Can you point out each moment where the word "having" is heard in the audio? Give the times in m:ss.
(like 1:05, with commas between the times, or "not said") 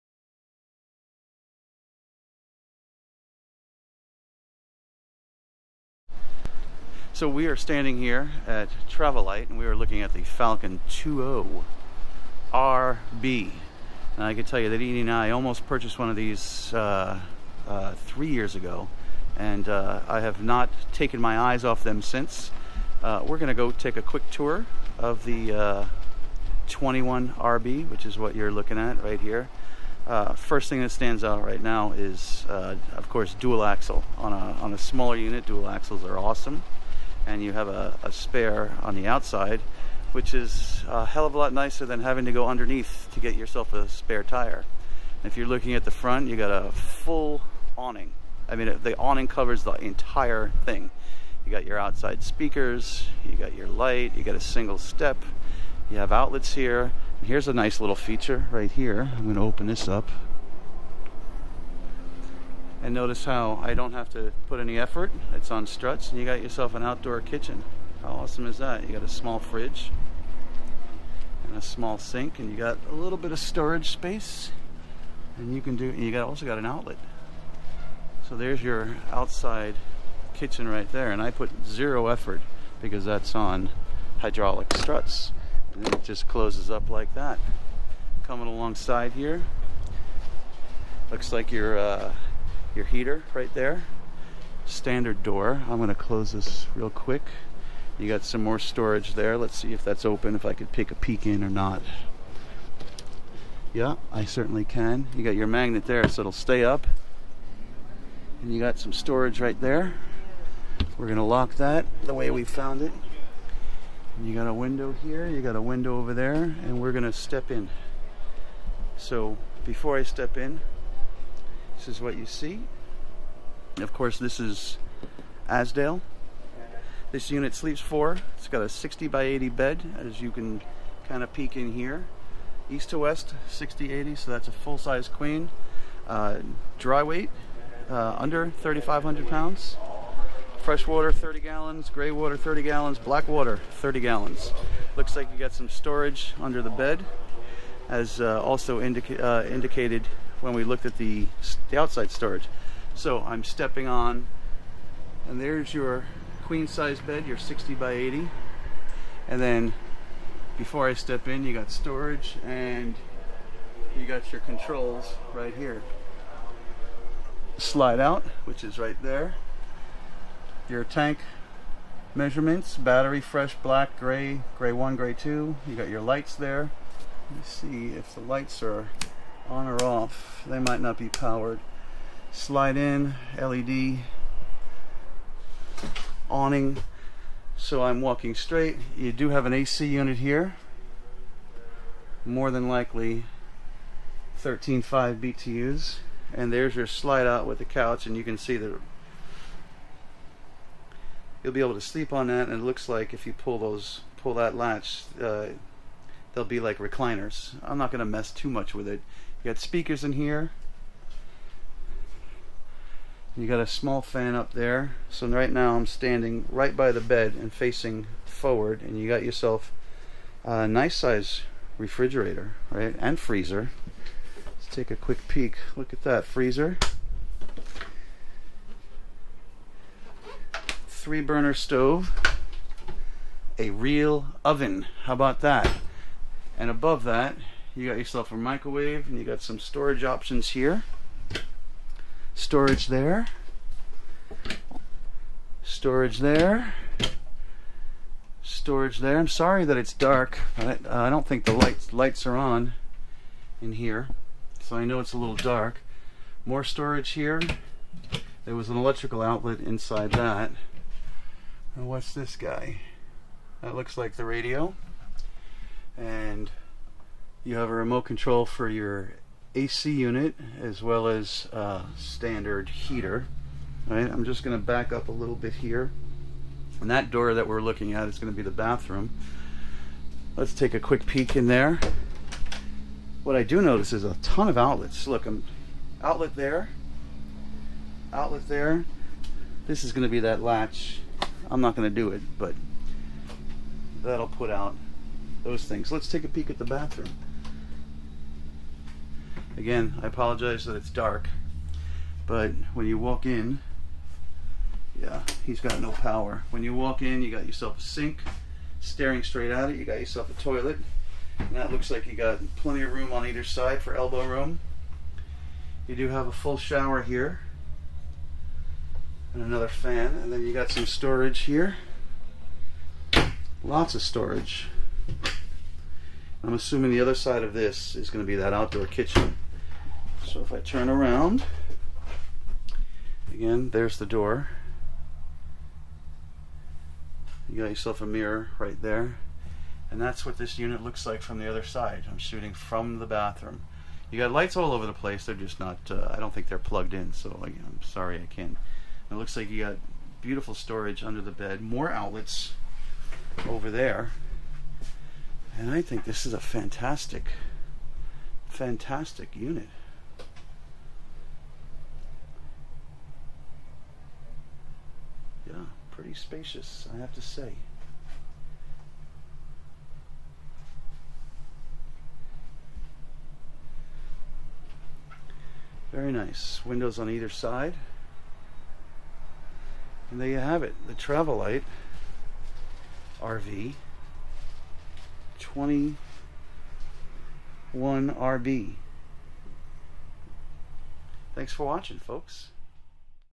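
0:42.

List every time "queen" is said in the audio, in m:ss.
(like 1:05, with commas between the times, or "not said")
2:15, 2:36.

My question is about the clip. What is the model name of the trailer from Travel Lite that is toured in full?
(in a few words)
21RB.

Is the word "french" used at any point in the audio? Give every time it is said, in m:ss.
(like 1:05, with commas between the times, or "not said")
not said.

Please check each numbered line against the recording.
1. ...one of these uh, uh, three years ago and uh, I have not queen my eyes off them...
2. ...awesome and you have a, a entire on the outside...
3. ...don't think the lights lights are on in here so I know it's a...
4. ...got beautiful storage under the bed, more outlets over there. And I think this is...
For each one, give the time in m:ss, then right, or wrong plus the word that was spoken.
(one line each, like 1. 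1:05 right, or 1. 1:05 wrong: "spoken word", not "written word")
1. 0:15 wrong: "taken", not "queen"
2. 0:36 wrong: "spare", not "entire"
3. 4:11 right
4. 5:49 right.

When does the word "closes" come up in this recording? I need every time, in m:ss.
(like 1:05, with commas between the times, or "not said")
1:26, 1:35.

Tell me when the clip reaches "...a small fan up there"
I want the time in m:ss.
3:33.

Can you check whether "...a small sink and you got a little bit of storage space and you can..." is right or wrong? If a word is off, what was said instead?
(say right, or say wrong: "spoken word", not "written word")
right.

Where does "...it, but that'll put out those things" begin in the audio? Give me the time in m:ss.
4:52.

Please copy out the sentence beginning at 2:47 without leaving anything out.
Slide out, which is right there.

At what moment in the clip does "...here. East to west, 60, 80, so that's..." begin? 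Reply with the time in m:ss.
2:11.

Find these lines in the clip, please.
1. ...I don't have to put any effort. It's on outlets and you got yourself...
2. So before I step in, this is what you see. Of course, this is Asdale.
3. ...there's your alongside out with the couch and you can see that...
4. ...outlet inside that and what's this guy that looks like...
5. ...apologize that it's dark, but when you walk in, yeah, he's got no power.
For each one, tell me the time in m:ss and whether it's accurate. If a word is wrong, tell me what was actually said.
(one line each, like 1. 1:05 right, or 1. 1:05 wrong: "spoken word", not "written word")
1. 1:03 wrong: "struts", not "outlets"
2. 1:58 right
3. 3:16 wrong: "slide", not "alongside"
4. 4:19 right
5. 5:00 right.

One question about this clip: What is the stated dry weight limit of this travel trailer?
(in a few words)
Under 3,500 pounds.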